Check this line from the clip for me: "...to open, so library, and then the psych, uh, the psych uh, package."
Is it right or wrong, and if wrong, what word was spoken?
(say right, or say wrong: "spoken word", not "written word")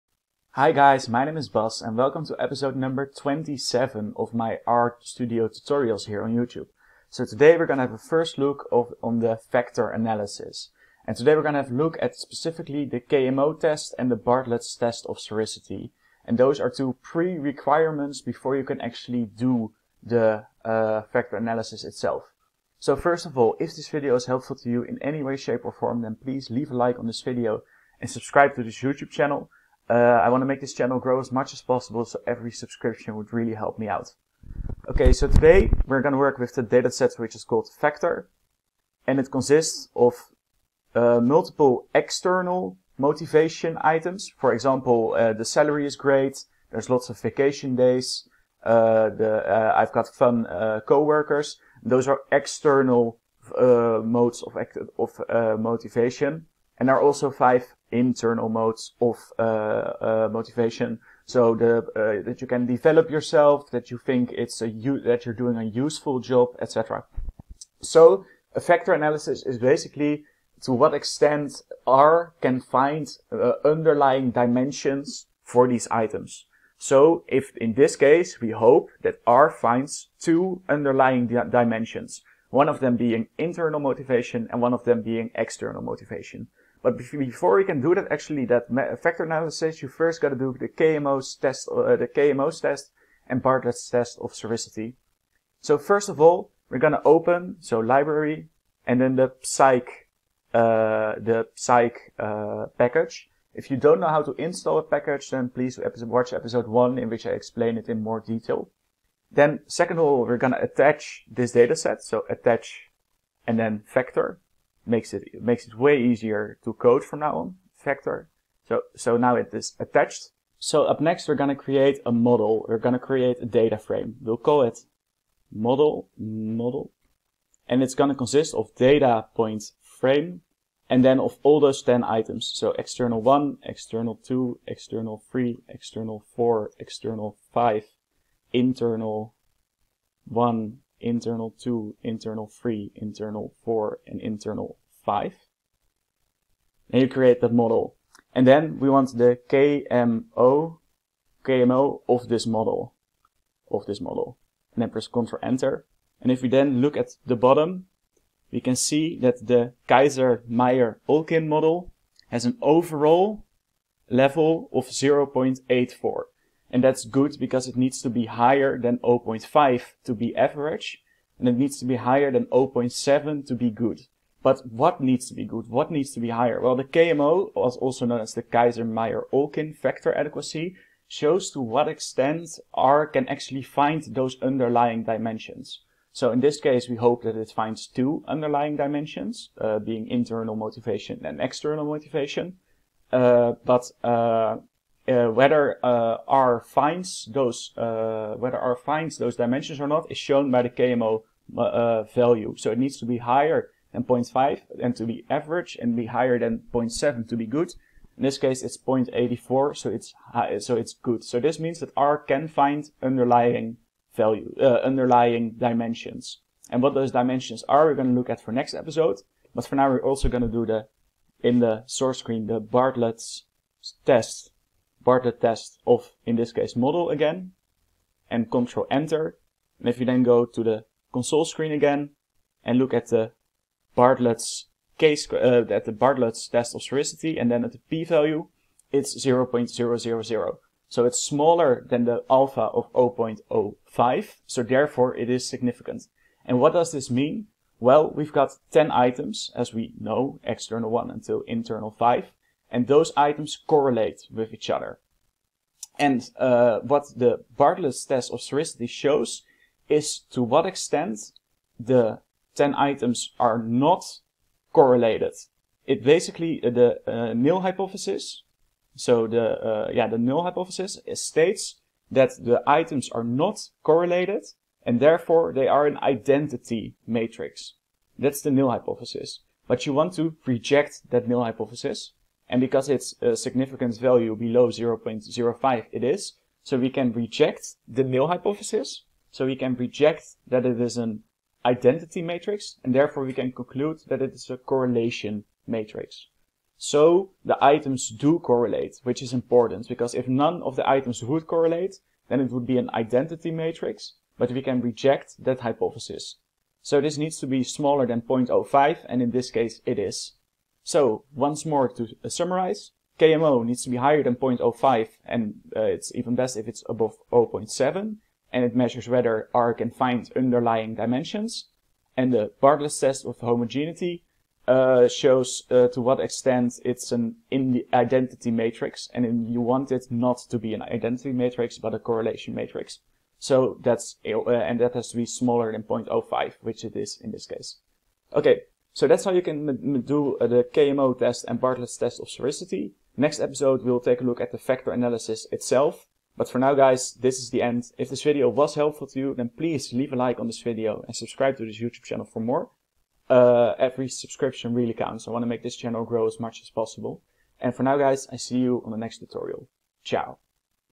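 right.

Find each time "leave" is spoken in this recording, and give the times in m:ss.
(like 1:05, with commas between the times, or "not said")
0:26, 5:49.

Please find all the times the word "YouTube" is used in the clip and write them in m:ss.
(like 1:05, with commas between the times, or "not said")
0:06, 0:28, 5:51.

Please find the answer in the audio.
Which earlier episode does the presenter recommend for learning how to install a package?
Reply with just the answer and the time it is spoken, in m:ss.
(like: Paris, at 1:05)
episode one, at 1:46.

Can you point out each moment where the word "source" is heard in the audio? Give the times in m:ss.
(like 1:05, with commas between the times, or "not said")
3:41.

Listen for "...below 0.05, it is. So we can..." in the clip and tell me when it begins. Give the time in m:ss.
4:44.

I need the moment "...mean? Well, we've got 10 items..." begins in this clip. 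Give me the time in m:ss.
4:07.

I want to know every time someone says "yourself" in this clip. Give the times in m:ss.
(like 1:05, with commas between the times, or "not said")
1:03.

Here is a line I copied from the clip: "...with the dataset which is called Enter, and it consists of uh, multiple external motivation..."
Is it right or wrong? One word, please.
wrong.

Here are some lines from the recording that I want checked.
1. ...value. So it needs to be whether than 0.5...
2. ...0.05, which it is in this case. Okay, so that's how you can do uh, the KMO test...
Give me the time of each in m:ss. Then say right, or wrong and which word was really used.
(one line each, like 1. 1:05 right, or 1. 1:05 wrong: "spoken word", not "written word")
1. 3:22 wrong: "higher", not "whether"
2. 5:35 right.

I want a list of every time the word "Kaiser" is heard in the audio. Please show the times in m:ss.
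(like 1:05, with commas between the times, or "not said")
2:39, 2:58.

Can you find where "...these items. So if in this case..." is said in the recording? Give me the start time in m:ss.
1:15.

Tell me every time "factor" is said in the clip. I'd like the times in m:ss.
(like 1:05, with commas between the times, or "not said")
0:09, 0:21, 1:08, 1:29, 1:53, 2:59, 5:44.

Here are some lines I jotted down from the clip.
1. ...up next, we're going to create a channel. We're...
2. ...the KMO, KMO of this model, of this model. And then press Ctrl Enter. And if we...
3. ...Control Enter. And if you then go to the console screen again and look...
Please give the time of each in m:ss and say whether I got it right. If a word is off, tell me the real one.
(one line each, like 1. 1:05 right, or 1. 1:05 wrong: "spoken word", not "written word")
1. 2:00 wrong: "model", not "channel"
2. 2:29 right
3. 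3:48 right.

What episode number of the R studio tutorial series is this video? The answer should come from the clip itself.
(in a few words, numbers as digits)
27.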